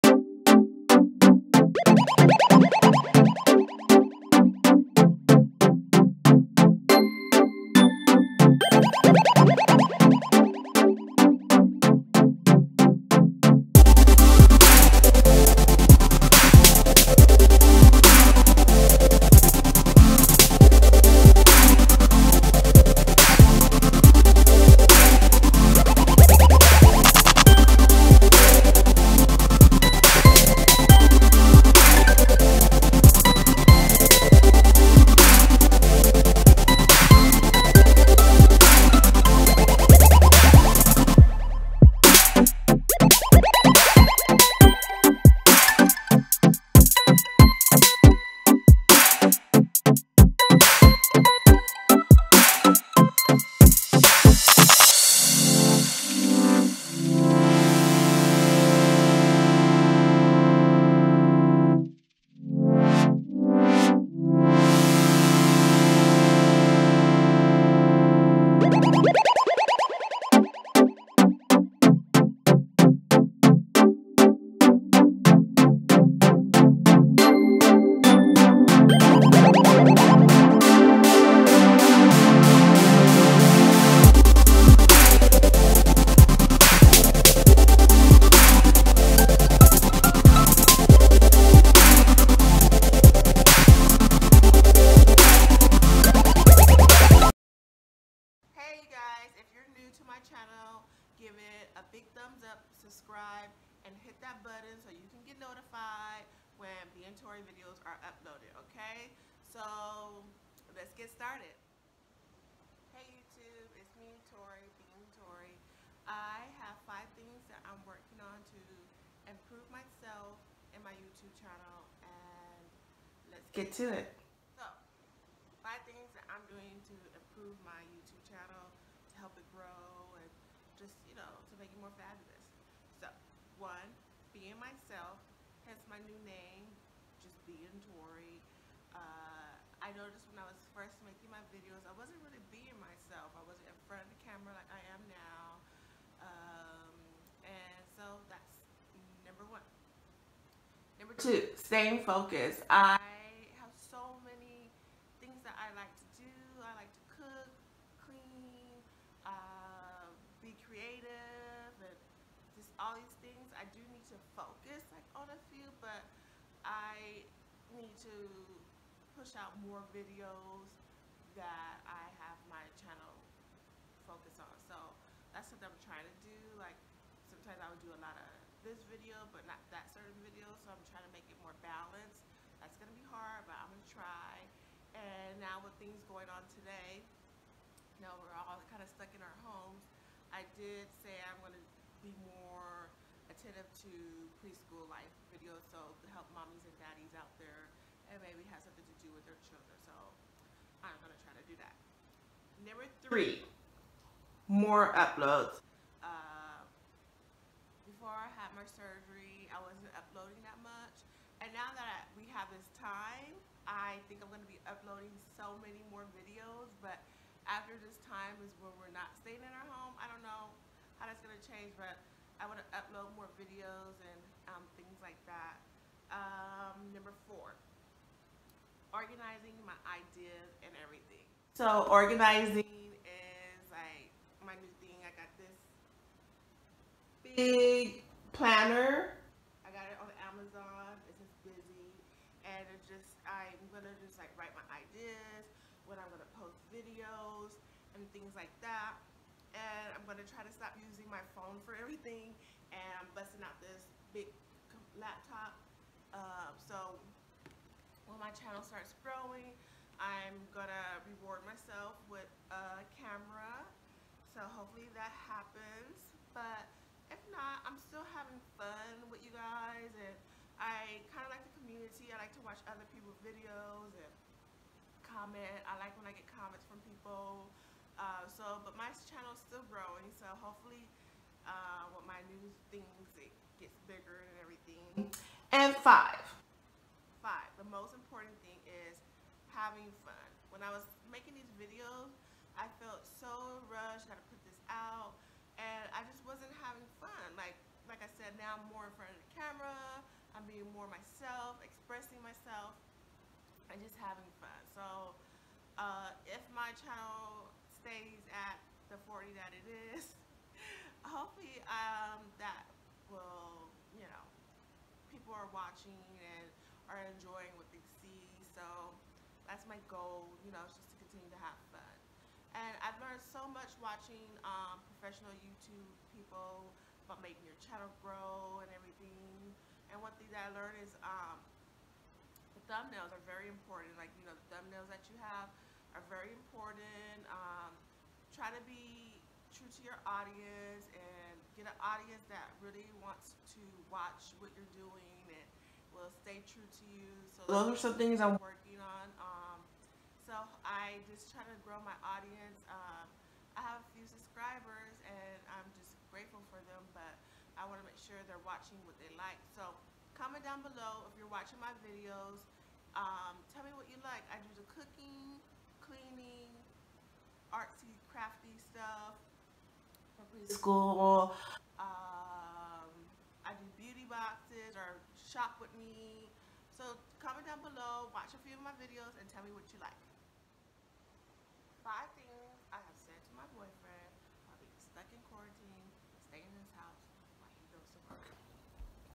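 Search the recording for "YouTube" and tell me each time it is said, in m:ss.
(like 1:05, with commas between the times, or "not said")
1:53, 2:00, 2:07, 5:25.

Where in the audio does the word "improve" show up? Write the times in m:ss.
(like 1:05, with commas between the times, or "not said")
1:59, 2:07.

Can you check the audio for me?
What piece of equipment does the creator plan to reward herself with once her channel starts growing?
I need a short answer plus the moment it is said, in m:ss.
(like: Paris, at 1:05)
A camera, at 4:22.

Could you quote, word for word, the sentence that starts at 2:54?
So that's something I'm trying to do.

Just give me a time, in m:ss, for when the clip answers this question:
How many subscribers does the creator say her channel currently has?
5:09.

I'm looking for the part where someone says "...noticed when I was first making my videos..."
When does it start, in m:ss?
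2:19.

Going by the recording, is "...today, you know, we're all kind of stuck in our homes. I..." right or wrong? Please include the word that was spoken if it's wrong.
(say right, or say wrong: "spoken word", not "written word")
right.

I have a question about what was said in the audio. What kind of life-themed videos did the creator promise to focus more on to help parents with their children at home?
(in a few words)
Preschool life videos.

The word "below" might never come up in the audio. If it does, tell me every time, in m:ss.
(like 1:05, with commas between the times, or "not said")
6:00, 6:17.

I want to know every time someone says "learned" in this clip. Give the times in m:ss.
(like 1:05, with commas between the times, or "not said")
5:23, 5:30.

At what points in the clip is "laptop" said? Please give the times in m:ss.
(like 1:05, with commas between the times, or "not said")
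4:14.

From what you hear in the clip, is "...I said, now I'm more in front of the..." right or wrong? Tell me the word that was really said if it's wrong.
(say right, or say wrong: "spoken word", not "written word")
right.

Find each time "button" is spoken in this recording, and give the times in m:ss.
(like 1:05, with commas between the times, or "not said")
1:44.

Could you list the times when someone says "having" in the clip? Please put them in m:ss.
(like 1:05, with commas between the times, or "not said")
4:28, 4:49, 4:56, 5:04.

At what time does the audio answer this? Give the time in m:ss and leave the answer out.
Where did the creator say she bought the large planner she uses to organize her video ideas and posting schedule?
4:00.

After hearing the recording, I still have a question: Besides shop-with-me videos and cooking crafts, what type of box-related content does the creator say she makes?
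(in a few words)
Beauty boxes.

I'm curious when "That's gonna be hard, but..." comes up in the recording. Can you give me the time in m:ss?
3:02.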